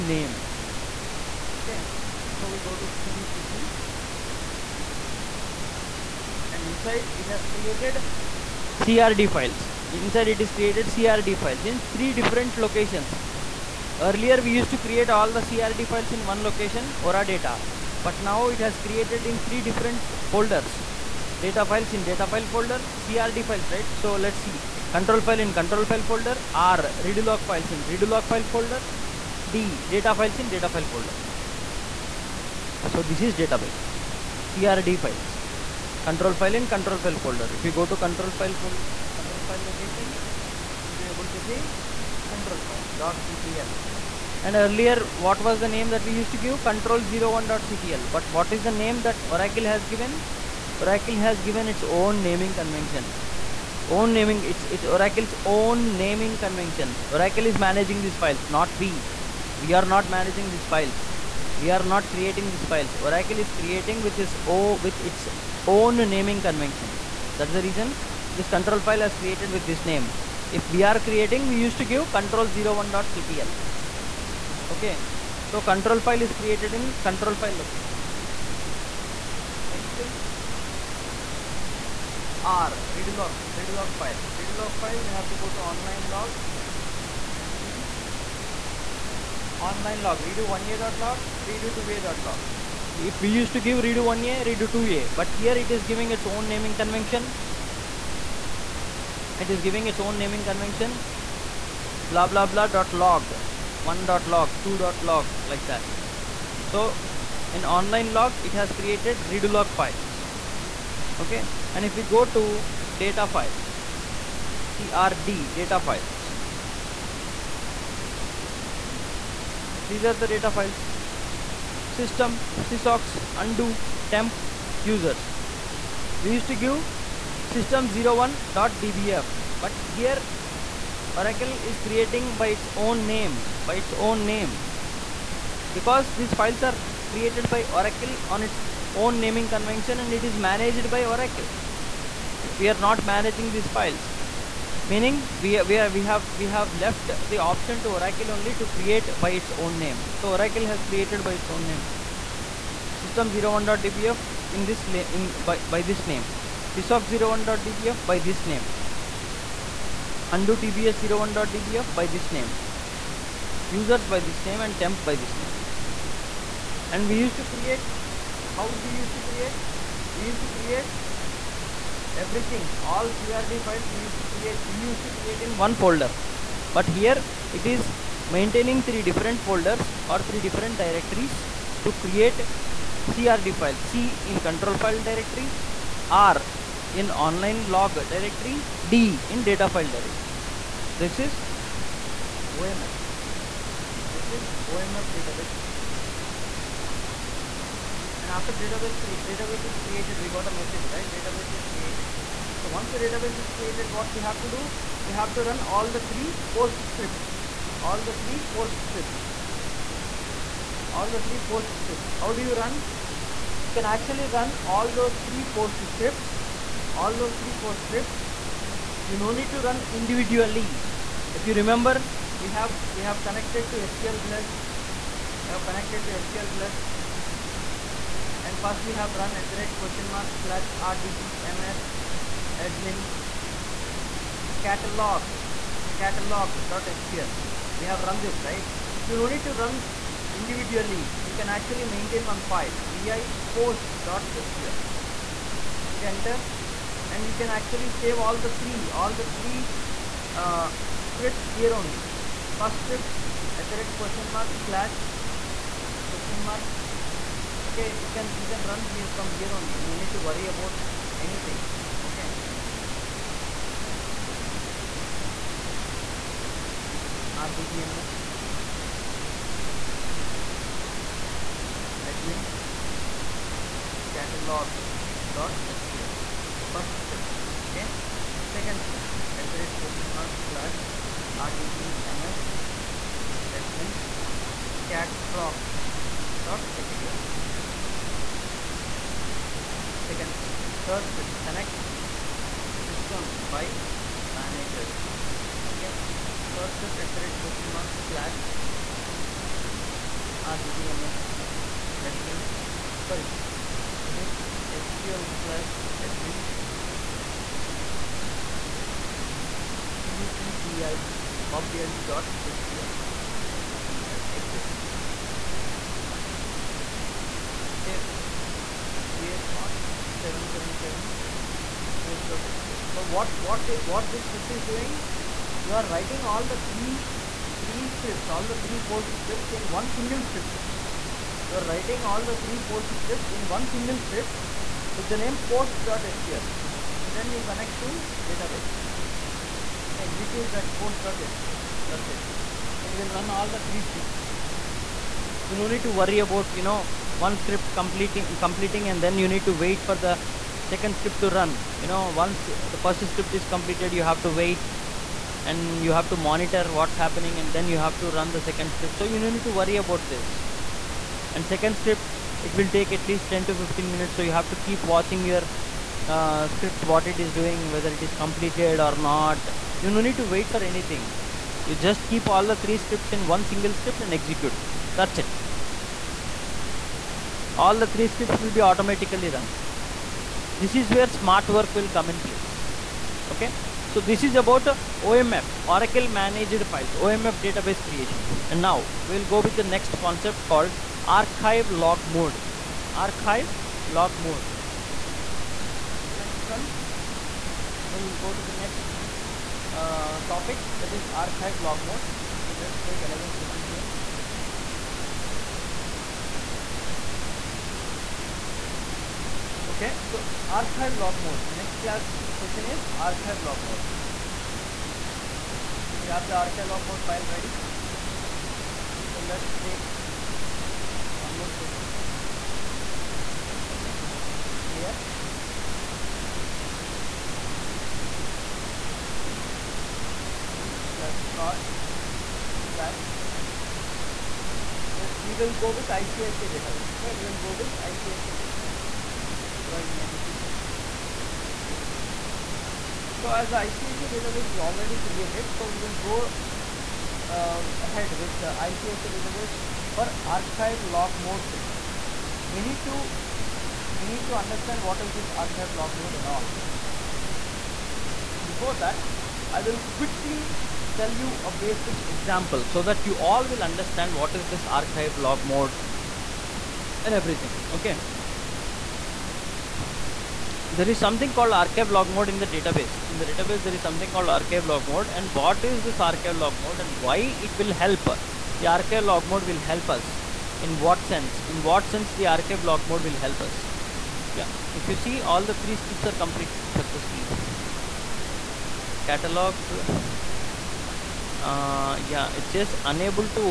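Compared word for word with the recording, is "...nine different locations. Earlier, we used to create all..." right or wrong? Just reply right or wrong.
wrong.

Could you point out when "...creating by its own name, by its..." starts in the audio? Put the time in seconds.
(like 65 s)
131 s.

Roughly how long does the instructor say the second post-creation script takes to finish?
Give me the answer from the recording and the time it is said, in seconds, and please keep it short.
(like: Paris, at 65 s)
10 to 15 minutes, at 363 s.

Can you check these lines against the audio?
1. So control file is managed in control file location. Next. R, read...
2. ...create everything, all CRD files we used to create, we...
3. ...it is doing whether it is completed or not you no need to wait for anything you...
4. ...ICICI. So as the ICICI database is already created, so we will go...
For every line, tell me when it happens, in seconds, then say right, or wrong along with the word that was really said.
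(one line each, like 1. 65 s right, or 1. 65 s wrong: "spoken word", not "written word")
1. 75 s wrong: "created", not "managed"
2. 170 s right
3. 367 s right
4. 441 s right.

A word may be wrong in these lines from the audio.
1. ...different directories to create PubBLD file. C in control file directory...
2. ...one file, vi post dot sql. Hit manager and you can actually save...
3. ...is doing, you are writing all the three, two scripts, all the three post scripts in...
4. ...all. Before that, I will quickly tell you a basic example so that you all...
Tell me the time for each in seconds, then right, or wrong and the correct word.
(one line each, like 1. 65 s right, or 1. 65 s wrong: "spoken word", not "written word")
1. 180 s wrong: "CRD", not "PubBLD"
2. 242 s wrong: "enter", not "manager"
3. 324 s wrong: "three", not "two"
4. 456 s right.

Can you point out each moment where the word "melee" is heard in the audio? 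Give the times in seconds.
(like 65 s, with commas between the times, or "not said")
not said.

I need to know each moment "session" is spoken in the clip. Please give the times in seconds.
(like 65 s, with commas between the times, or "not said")
403 s, 412 s, 421 s, 451 s.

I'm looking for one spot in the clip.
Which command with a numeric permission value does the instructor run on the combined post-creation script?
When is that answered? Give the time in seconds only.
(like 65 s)
319 s.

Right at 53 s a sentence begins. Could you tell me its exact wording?
Own naming, it's it's Oracle's own naming convention.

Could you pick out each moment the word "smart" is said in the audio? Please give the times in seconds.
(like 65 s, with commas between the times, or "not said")
381 s.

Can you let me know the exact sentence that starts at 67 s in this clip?
That's the reason this control file is created with this name.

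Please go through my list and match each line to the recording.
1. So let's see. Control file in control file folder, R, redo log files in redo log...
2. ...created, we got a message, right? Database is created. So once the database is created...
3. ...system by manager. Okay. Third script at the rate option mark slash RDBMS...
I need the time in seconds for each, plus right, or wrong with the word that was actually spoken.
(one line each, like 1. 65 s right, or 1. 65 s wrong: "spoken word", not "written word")
1. 23 s right
2. 199 s right
3. 292 s wrong: "question", not "option".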